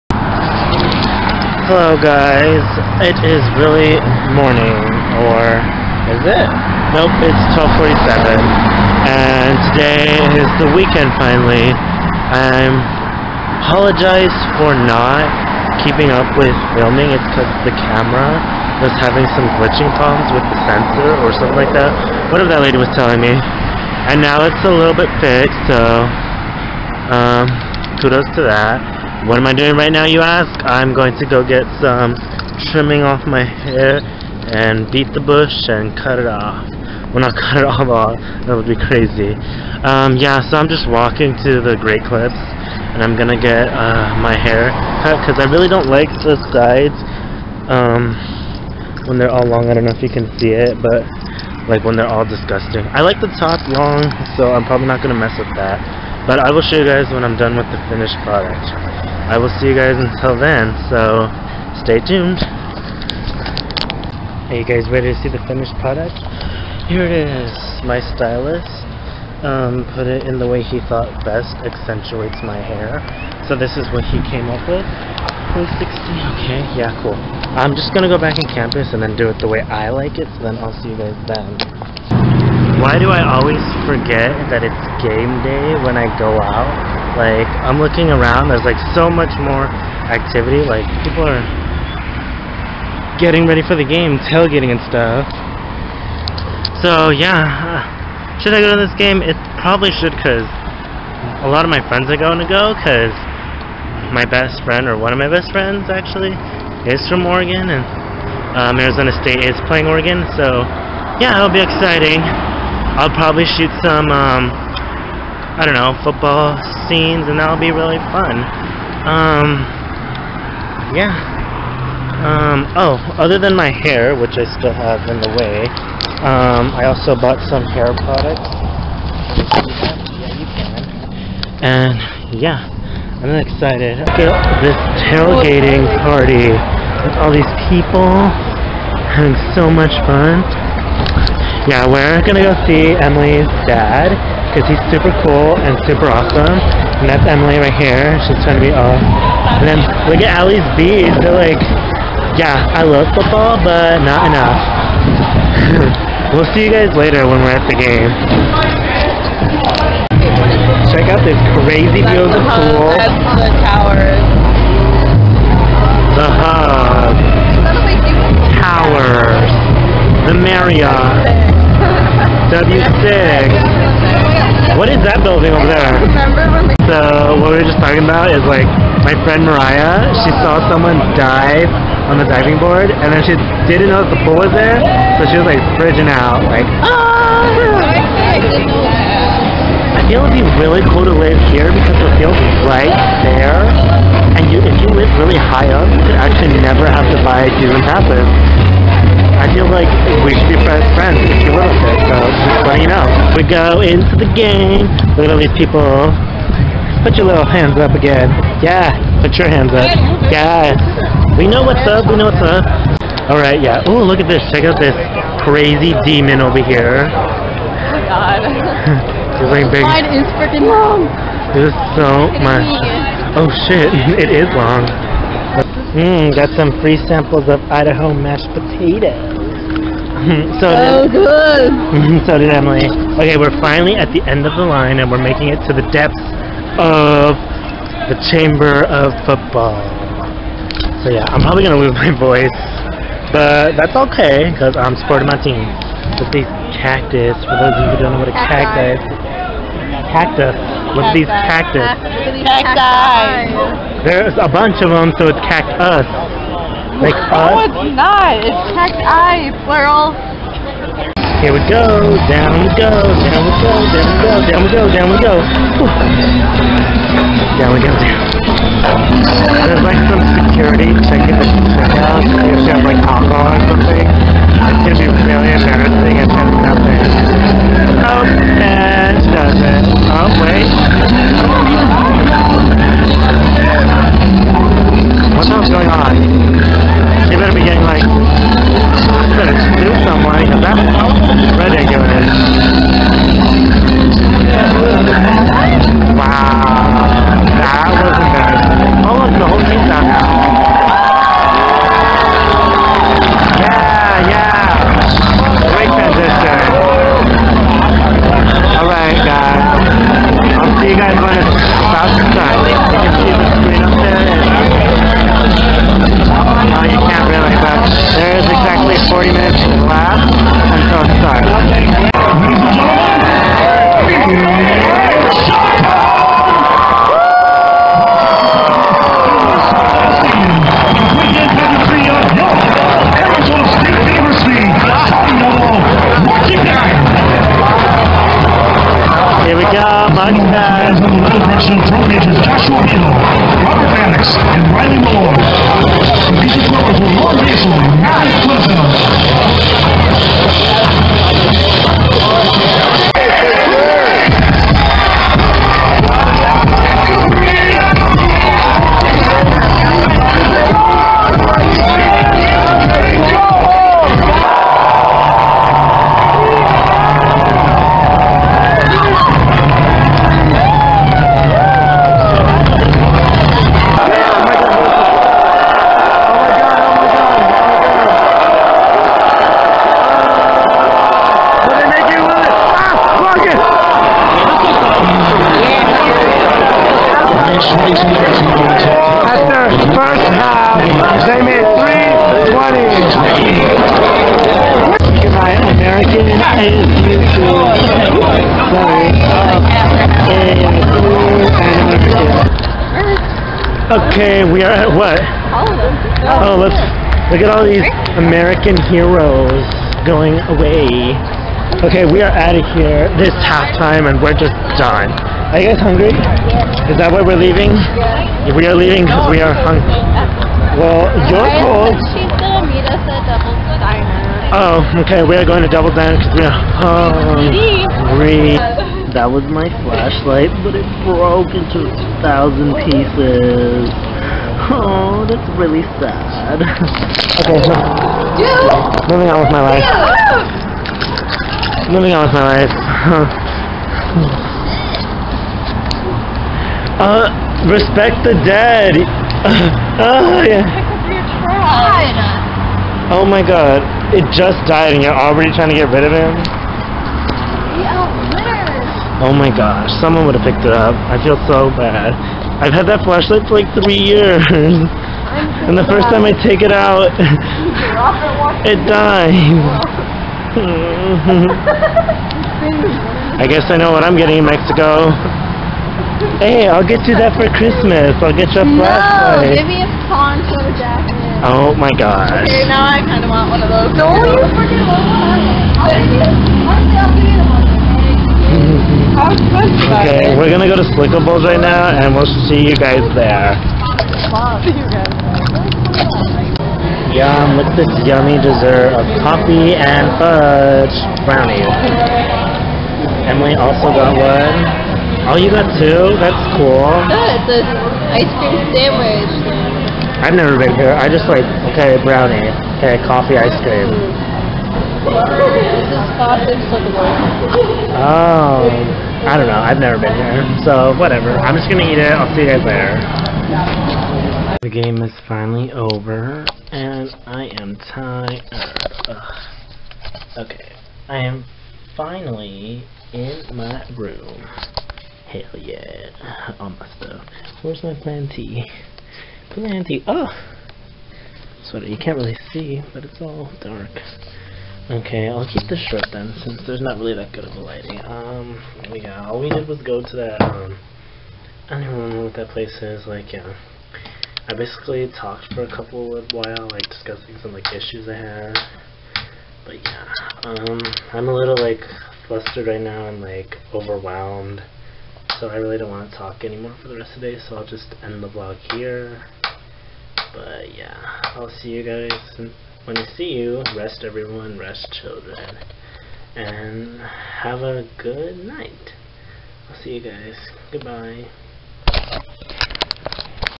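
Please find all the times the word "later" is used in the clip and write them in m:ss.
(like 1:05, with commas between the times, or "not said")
2:36, 8:42.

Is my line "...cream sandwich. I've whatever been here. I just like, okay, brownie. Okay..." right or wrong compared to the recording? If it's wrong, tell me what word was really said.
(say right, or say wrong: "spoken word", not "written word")
wrong: "never", not "whatever".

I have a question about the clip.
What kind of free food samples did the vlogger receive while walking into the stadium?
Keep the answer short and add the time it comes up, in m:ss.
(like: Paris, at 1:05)
Idaho mashed potatoes, at 3:47.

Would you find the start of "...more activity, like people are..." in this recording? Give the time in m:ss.
1:29.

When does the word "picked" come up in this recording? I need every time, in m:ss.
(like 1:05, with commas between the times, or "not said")
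7:40.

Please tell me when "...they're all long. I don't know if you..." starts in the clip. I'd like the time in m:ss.
0:49.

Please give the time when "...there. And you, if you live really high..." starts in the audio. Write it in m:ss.
3:13.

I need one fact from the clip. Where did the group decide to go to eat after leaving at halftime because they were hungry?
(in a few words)
Devil's Diner.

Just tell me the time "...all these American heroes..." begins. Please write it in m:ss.
6:47.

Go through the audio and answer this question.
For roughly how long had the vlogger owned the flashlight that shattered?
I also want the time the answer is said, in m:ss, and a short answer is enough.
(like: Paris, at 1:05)
3 years, at 7:43.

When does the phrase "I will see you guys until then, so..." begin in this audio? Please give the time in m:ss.
0:59.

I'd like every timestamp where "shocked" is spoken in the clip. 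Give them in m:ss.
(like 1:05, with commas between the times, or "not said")
not said.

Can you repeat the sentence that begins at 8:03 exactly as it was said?
Don't no, you freaking want one.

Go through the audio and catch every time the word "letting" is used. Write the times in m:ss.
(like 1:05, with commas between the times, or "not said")
3:22.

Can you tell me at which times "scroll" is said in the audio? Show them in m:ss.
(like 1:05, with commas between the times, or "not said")
not said.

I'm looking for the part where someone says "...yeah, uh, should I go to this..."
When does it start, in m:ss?
1:37.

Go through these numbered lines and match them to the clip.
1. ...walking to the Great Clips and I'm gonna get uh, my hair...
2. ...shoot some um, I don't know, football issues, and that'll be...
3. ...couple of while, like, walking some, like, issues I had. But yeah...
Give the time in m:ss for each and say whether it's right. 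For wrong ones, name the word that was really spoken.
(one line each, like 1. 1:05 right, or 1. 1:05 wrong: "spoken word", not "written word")
1. 0:40 right
2. 1:53 wrong: "scenes", not "issues"
3. 9:15 wrong: "discussing", not "walking".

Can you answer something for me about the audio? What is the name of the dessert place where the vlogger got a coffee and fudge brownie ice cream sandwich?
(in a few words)
Slickables.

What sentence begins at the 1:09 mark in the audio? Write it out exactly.
Um, put it in the way he thought best accentuates my hair.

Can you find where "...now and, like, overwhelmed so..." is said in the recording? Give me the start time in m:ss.
9:22.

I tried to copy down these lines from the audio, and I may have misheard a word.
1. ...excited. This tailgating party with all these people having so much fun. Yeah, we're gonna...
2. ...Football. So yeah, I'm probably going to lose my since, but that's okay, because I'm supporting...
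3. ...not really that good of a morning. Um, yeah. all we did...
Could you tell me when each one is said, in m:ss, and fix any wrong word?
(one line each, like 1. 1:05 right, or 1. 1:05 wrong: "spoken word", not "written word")
1. 2:13 right
2. 3:59 wrong: "voice", not "since"
3. 9:06 wrong: "lighting", not "morning".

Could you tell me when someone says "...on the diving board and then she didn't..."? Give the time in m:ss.
3:02.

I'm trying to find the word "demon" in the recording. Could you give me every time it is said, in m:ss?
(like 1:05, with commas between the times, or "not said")
3:36.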